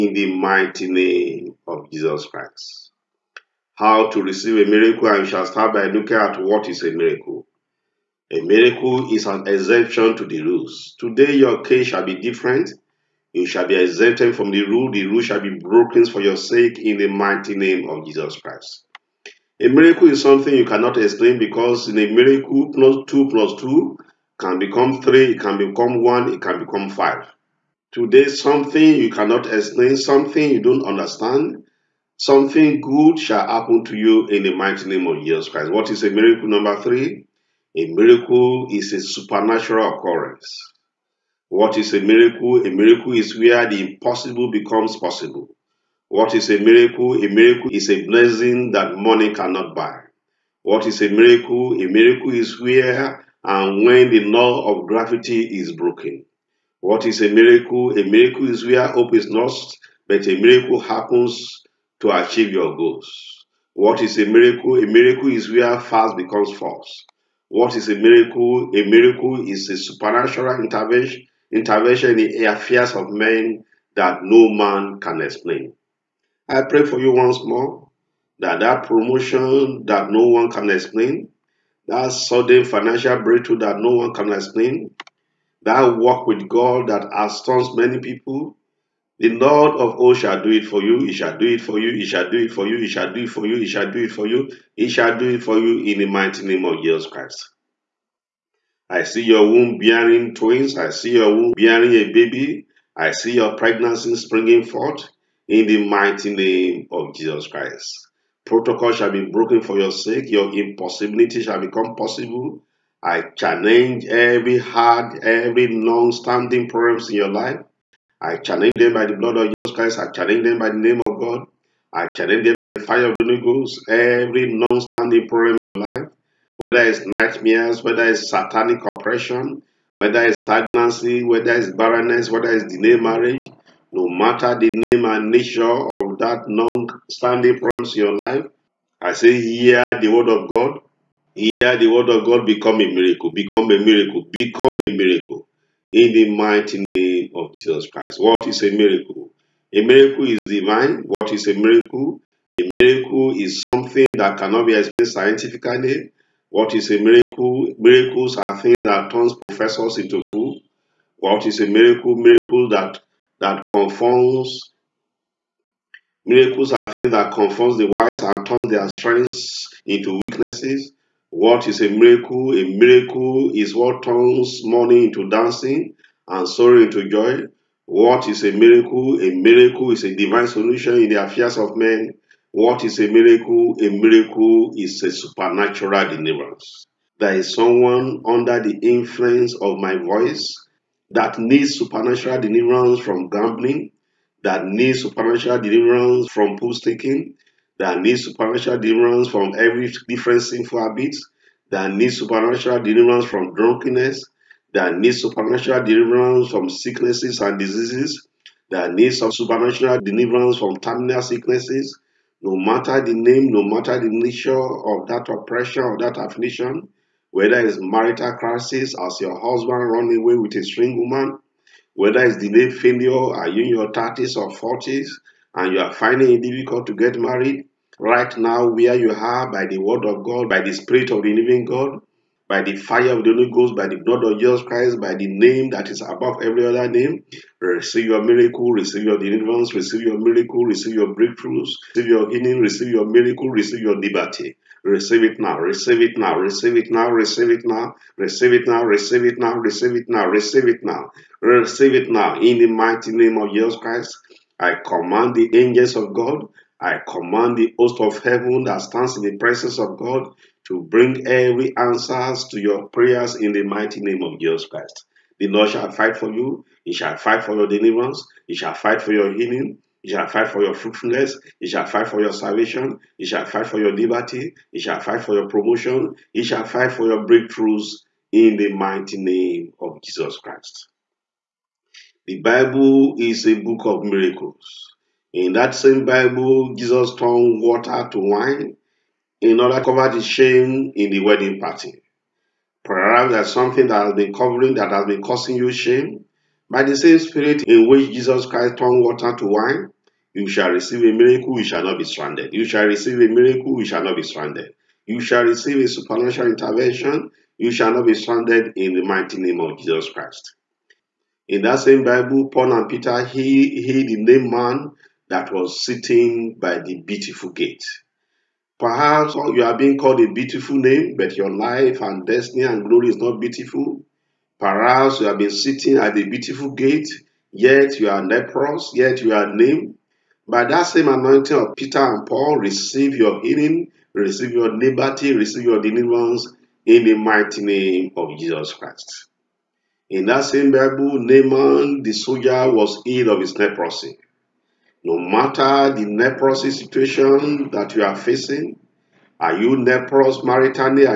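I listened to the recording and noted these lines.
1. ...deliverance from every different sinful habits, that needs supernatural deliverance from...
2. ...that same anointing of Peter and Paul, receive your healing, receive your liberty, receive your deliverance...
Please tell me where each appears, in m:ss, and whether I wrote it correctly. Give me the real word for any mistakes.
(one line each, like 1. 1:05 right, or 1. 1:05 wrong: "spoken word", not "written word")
1. 3:18 right
2. 5:30 right.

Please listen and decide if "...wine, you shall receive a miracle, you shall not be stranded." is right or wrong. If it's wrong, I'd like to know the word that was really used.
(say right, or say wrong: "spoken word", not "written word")
right.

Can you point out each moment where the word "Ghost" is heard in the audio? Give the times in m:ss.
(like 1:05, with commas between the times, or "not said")
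2:03, 3:53.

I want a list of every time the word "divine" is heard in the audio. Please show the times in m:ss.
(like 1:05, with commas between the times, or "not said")
2:30, 3:00.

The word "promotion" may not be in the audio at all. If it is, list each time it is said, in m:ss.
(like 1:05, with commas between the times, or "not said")
1:18, 4:35.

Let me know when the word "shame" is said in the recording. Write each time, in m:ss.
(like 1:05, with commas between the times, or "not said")
4:50, 4:55.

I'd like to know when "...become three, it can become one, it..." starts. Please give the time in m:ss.
0:24.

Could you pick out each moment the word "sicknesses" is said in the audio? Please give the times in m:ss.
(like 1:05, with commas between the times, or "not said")
3:26, 3:31.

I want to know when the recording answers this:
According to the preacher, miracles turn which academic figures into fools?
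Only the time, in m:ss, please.
2:39.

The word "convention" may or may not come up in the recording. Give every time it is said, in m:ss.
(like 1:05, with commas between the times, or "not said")
not said.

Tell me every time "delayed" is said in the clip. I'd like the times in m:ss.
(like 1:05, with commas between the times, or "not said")
2:12, 3:42.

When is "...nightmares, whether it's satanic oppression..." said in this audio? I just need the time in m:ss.
2:07.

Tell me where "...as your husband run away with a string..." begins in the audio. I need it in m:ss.
3:38.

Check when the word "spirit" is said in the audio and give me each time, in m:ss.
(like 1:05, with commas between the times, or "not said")
3:50, 4:57.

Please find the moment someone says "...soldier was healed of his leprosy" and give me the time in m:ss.
5:42.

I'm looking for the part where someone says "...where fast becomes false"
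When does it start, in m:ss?
1:05.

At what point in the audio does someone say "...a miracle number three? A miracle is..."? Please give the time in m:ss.
0:36.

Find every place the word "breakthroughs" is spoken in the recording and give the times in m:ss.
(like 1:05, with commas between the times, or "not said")
1:23, 4:01, 4:37.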